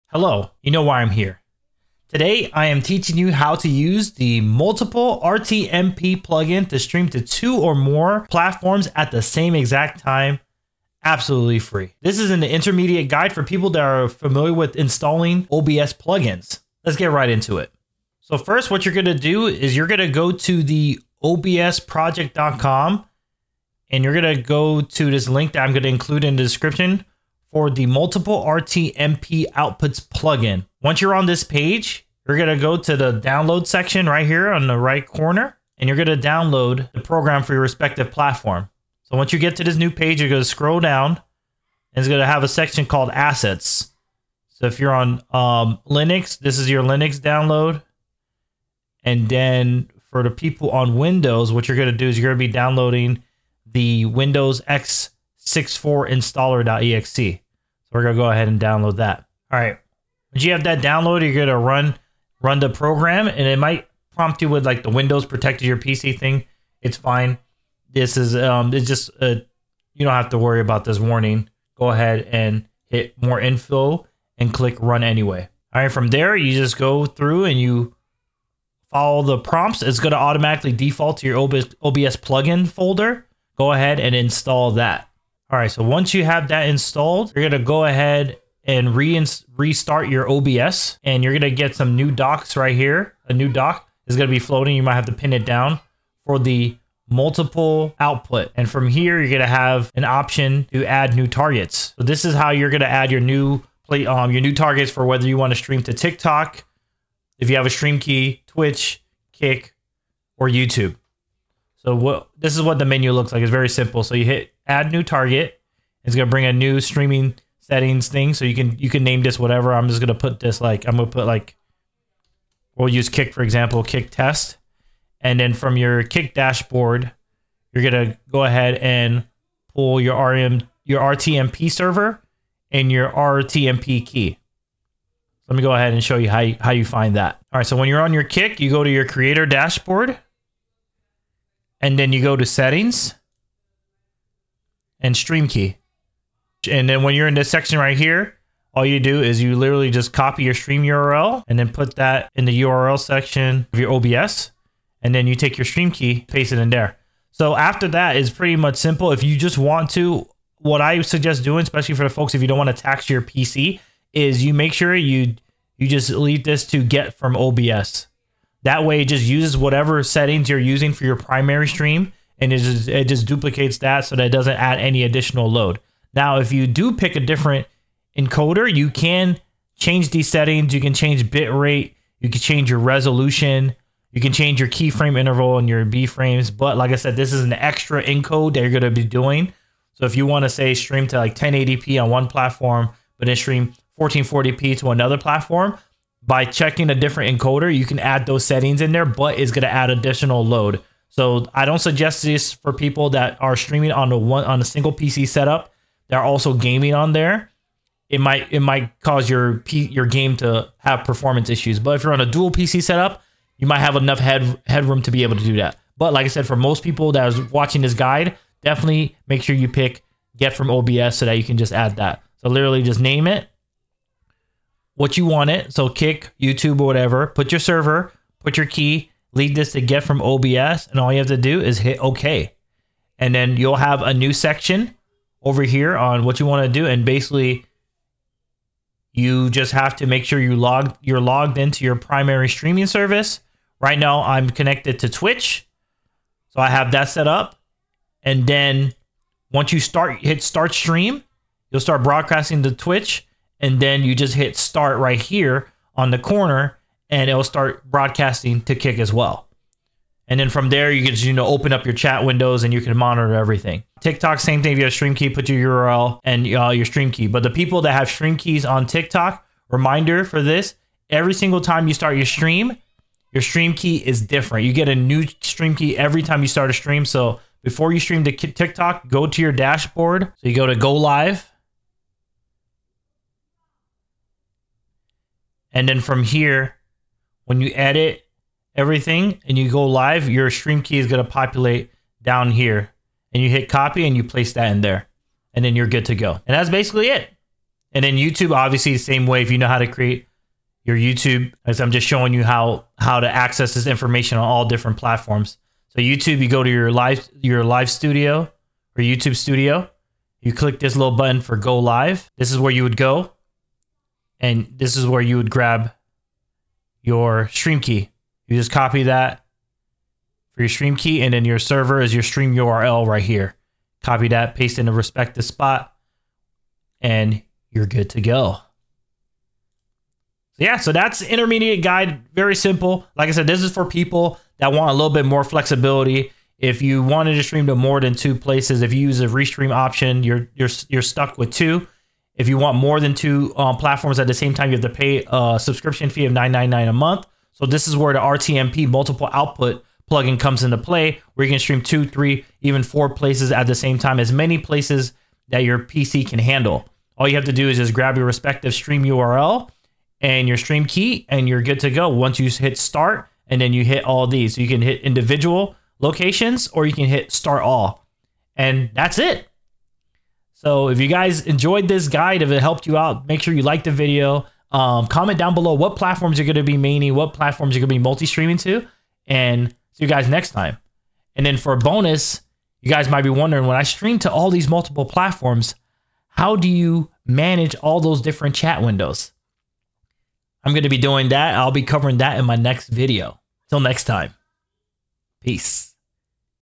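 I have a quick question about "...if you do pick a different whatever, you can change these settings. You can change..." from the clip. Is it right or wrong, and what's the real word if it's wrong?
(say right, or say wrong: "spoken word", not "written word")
wrong: "encoder", not "whatever".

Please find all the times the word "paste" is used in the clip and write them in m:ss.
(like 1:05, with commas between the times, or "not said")
2:36, 5:24.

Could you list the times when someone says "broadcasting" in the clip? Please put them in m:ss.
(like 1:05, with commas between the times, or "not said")
4:12, 4:17.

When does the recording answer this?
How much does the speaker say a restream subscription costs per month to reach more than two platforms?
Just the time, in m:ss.
5:46.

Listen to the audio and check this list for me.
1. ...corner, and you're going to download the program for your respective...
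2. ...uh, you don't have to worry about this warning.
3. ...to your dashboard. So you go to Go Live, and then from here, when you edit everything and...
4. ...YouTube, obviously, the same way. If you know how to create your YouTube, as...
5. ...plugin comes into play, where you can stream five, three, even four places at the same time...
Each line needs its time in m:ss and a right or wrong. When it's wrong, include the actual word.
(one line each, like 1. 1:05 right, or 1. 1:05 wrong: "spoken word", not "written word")
1. 0:35 right
2. 1:09 right
3. 4:39 right
4. 4:58 right
5. 5:50 wrong: "two", not "five".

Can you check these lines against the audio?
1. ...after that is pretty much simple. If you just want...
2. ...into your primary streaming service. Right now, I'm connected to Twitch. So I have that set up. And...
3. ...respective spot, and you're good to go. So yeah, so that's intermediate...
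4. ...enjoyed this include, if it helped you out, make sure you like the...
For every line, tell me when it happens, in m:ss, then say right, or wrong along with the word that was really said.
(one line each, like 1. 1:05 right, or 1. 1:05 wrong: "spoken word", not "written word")
1. 2:37 right
2. 4:01 right
3. 5:24 right
4. 6:11 wrong: "guide", not "include".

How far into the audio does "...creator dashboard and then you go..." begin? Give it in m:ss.
2:19.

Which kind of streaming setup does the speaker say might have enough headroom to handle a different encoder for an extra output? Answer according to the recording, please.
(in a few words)
dual PC setup.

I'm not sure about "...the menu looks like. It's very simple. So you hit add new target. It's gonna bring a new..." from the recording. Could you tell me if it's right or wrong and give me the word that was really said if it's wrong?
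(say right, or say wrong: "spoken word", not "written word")
right.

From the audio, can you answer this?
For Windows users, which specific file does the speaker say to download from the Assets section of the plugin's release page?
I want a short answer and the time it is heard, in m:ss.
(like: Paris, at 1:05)
Windows x64 installer.exe, at 0:54.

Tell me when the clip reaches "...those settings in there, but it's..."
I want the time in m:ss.
3:18.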